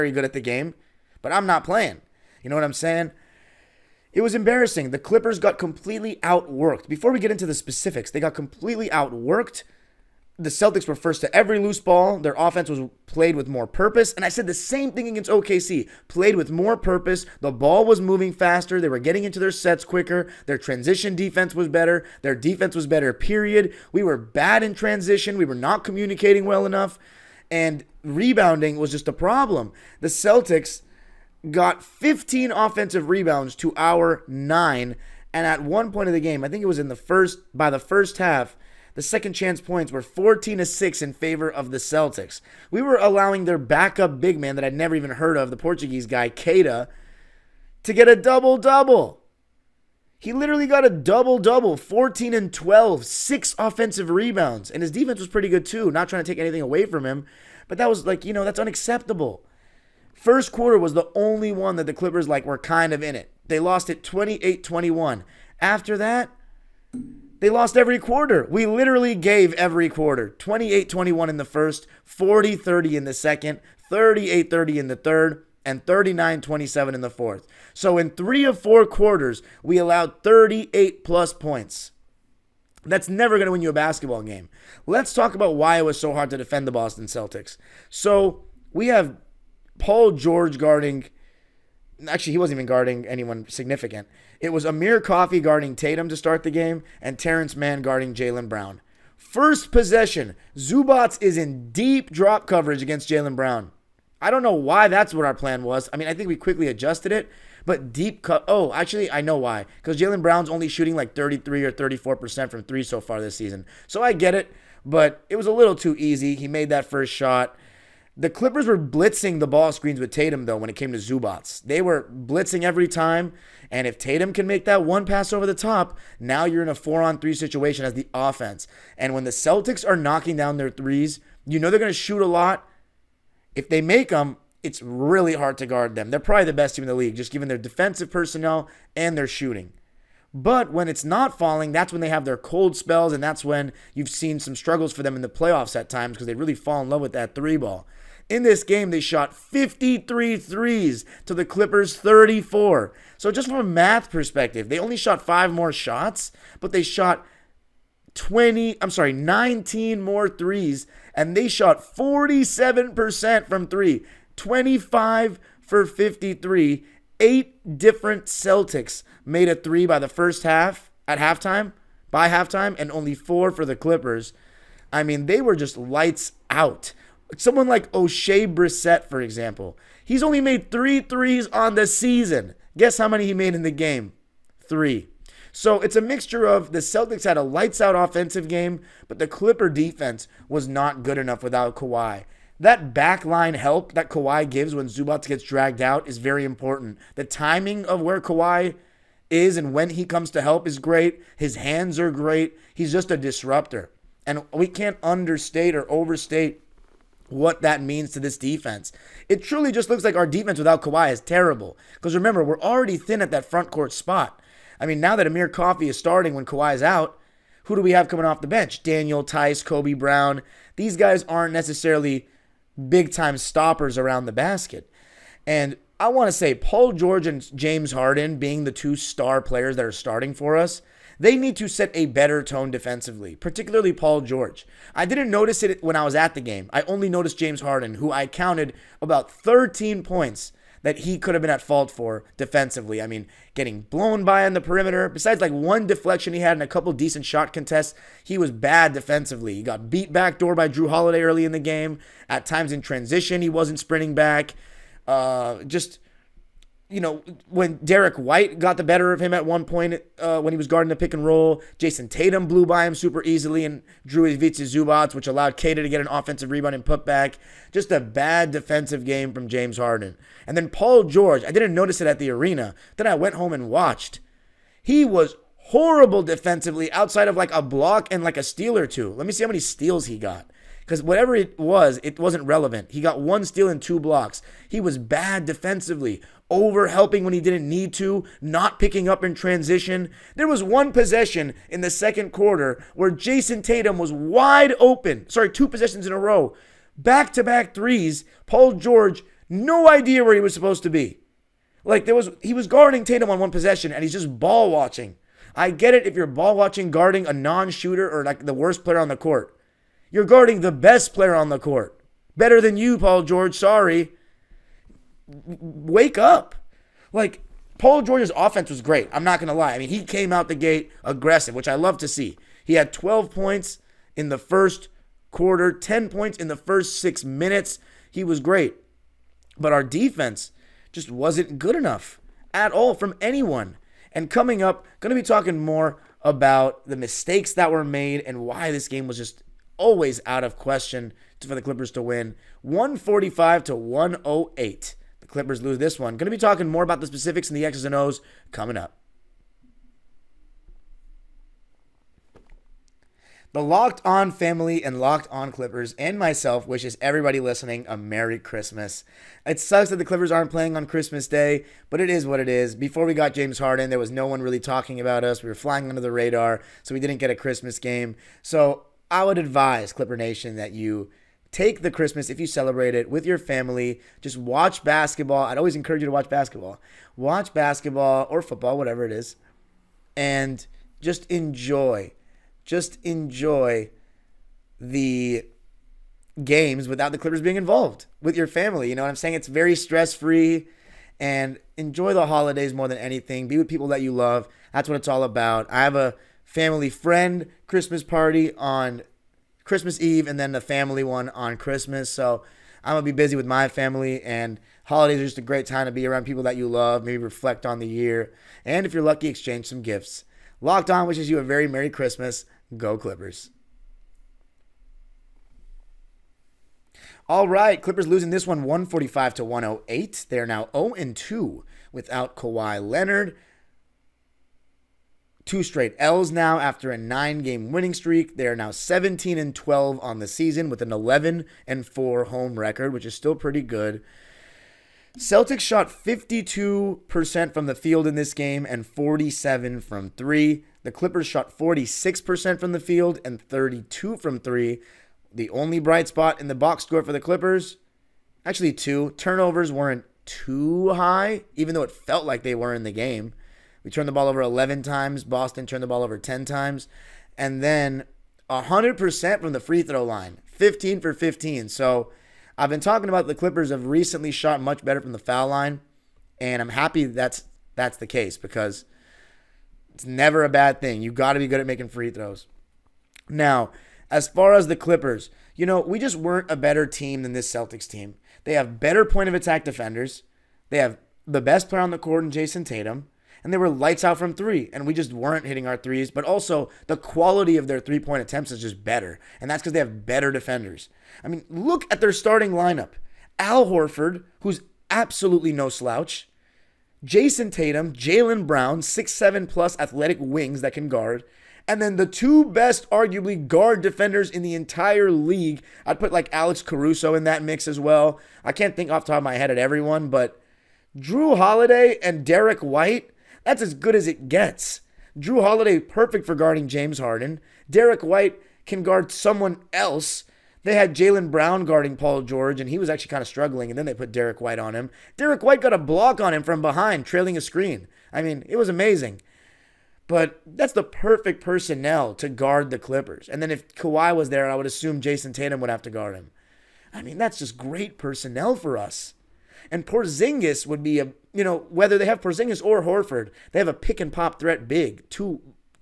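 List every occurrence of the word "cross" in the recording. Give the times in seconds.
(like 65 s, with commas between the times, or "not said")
not said.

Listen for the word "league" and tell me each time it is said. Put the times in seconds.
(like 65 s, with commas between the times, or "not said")
136 s, 505 s.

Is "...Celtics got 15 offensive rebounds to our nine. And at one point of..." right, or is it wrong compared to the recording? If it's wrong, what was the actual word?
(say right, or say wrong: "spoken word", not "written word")
right.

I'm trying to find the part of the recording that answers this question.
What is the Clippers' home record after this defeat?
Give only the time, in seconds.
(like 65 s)
430 s.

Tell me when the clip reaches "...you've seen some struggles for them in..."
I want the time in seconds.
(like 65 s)
143 s.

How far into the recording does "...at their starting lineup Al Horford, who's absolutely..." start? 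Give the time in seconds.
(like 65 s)
491 s.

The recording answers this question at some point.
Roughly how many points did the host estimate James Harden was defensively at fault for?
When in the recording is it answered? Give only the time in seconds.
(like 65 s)
239 s.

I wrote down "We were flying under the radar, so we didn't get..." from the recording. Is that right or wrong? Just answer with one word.
right.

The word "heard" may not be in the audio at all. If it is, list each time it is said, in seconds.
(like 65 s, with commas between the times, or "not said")
45 s.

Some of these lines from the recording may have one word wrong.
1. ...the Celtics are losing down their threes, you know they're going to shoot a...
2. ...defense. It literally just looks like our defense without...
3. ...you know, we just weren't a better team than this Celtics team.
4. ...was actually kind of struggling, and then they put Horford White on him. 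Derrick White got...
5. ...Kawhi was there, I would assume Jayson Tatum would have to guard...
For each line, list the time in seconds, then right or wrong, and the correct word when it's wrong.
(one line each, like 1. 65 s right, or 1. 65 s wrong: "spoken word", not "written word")
1. 129 s wrong: "knocking", not "losing"
2. 208 s wrong: "truly", not "literally"
3. 475 s right
4. 522 s wrong: "Derrick", not "Horford"
5. 533 s right.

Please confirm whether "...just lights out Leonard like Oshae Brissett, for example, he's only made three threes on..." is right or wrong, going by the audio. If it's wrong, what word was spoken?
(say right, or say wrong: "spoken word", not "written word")
wrong: "Someone", not "Leonard".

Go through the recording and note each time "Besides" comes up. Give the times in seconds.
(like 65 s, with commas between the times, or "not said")
245 s.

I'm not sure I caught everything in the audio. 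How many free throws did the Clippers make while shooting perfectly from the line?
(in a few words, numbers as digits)
15.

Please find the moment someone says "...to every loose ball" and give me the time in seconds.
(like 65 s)
11 s.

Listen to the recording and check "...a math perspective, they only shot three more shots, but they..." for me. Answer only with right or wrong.
wrong.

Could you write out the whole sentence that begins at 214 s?
I mean, now that Amir Coffey is starting when Kawhi is out, who do we have coming off the bench?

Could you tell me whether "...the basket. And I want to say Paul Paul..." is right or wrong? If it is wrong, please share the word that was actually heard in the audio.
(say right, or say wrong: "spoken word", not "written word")
wrong: "George", not "Paul".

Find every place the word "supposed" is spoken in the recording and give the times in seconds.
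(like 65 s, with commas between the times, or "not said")
300 s.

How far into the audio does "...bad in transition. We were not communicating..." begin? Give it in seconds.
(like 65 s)
24 s.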